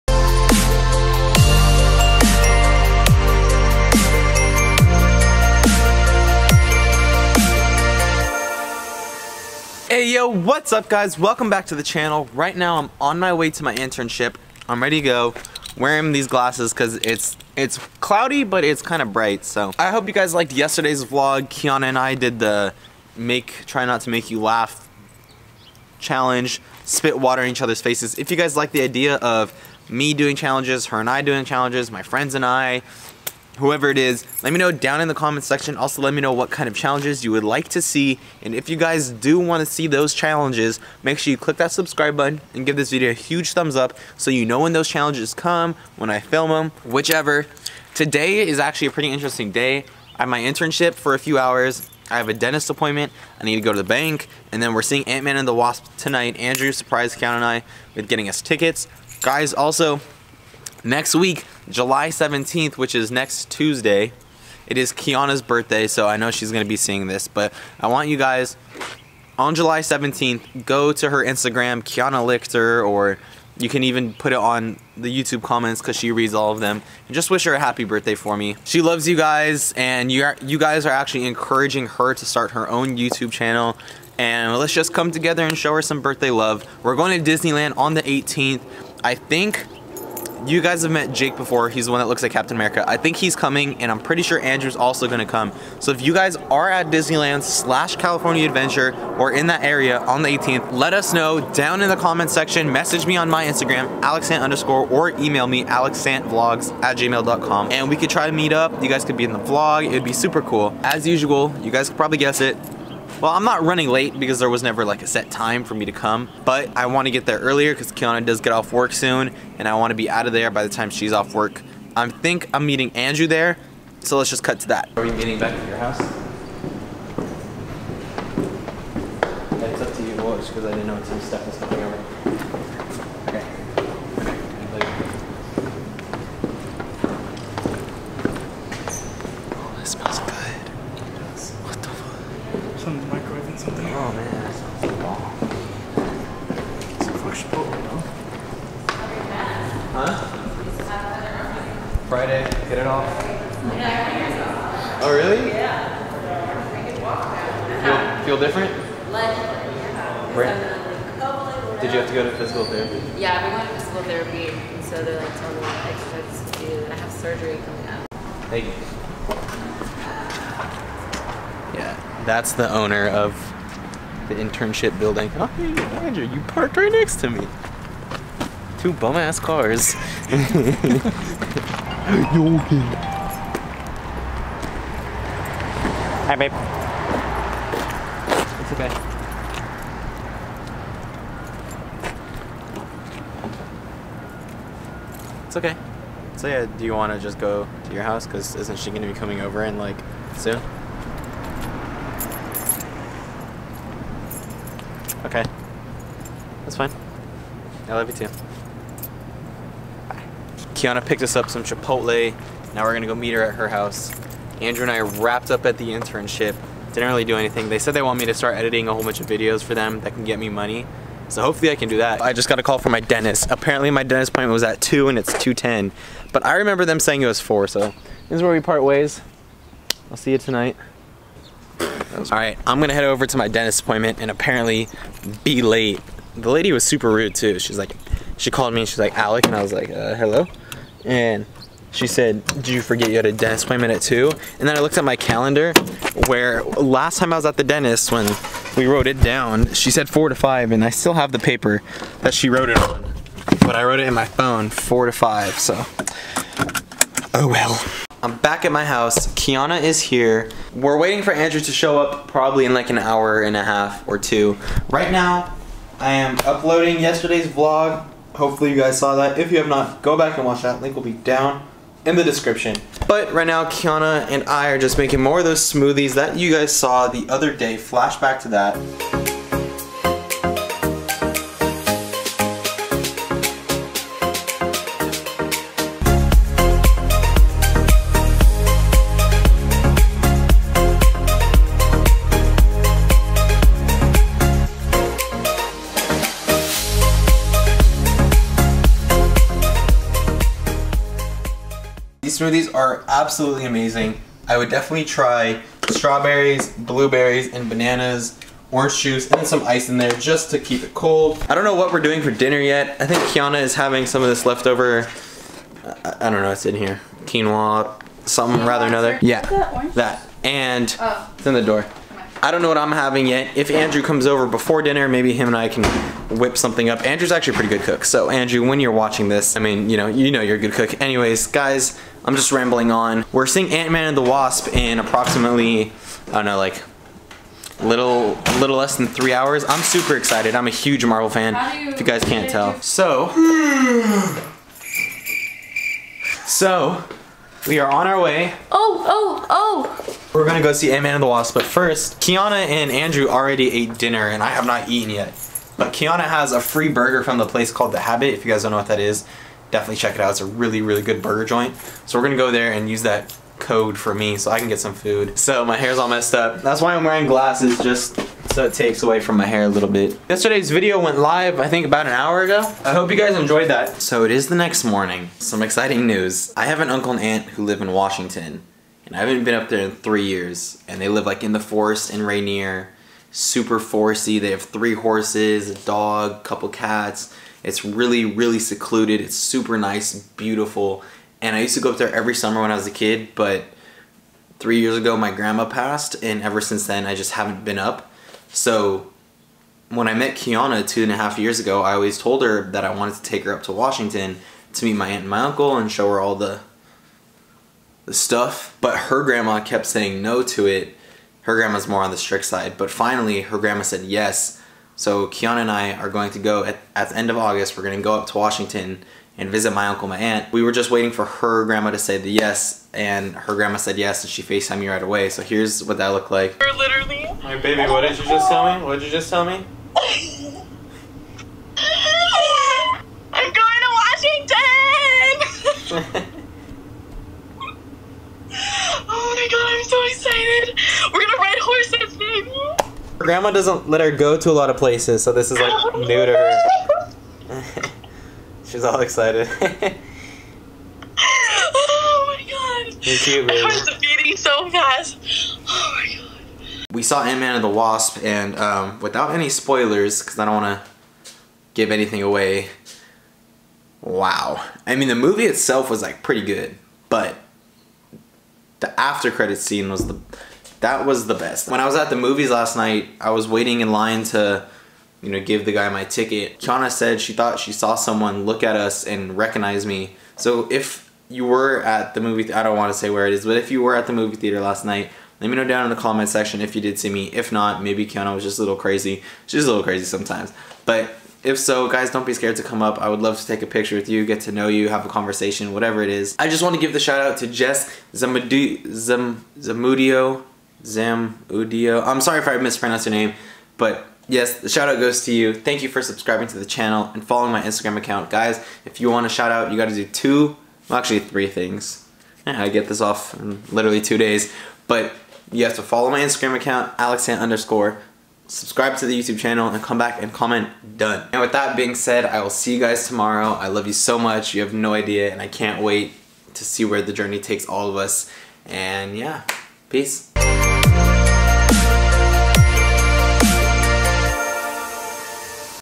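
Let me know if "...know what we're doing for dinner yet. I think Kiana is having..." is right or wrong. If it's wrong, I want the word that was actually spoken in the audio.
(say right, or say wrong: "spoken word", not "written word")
right.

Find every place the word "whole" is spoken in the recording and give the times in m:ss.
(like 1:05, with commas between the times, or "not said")
3:38.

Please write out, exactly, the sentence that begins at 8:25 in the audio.
Thank you for subscribing to the channel and following my Instagram account.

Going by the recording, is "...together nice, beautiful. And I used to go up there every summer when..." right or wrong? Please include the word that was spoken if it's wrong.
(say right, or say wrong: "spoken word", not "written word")
wrong: "super", not "together".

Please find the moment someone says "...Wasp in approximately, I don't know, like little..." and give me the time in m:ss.
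5:34.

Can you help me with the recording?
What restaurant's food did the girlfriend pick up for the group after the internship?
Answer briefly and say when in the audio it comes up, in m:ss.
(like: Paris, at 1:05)
Chipotle, at 3:31.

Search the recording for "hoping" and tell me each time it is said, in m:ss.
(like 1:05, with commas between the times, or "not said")
not said.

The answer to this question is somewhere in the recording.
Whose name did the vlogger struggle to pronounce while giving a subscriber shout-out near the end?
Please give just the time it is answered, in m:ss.
8:17.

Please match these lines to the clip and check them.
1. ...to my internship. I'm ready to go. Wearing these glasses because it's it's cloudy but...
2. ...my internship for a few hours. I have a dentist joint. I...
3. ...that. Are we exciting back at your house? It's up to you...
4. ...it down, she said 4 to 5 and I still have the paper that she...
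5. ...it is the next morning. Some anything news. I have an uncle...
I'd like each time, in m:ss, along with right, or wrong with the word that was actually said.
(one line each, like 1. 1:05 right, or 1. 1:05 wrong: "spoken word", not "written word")
1. 0:13 right
2. 0:50 wrong: "appointment", not "joint"
3. 2:04 wrong: "meeting", not "exciting"
4. 4:09 right
5. 6:14 wrong: "exciting", not "anything".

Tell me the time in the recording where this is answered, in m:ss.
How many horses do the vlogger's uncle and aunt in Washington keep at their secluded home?
6:24.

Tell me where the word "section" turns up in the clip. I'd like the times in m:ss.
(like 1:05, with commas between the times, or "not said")
0:35, 1:42, 8:06.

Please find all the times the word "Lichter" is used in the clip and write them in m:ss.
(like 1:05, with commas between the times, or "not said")
1:12.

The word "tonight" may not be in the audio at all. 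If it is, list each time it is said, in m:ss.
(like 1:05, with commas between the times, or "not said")
0:55, 3:50.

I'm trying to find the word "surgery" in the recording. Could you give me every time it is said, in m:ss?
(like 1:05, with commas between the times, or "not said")
2:47.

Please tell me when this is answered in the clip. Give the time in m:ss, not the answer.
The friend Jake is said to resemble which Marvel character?
1:32.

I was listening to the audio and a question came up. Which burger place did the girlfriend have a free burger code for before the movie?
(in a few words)
The Habit.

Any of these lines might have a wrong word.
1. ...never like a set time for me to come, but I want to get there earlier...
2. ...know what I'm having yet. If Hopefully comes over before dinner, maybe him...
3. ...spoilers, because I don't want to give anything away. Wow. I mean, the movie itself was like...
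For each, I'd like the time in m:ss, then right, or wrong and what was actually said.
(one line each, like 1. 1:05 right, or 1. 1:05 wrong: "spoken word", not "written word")
1. 1:54 right
2. 5:22 wrong: "Andrew", not "Hopefully"
3. 7:39 right.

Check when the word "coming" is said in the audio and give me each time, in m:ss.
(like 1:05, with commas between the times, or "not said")
1:33, 2:11, 2:47, 3:19.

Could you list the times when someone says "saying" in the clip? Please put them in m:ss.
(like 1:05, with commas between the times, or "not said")
3:46, 6:49.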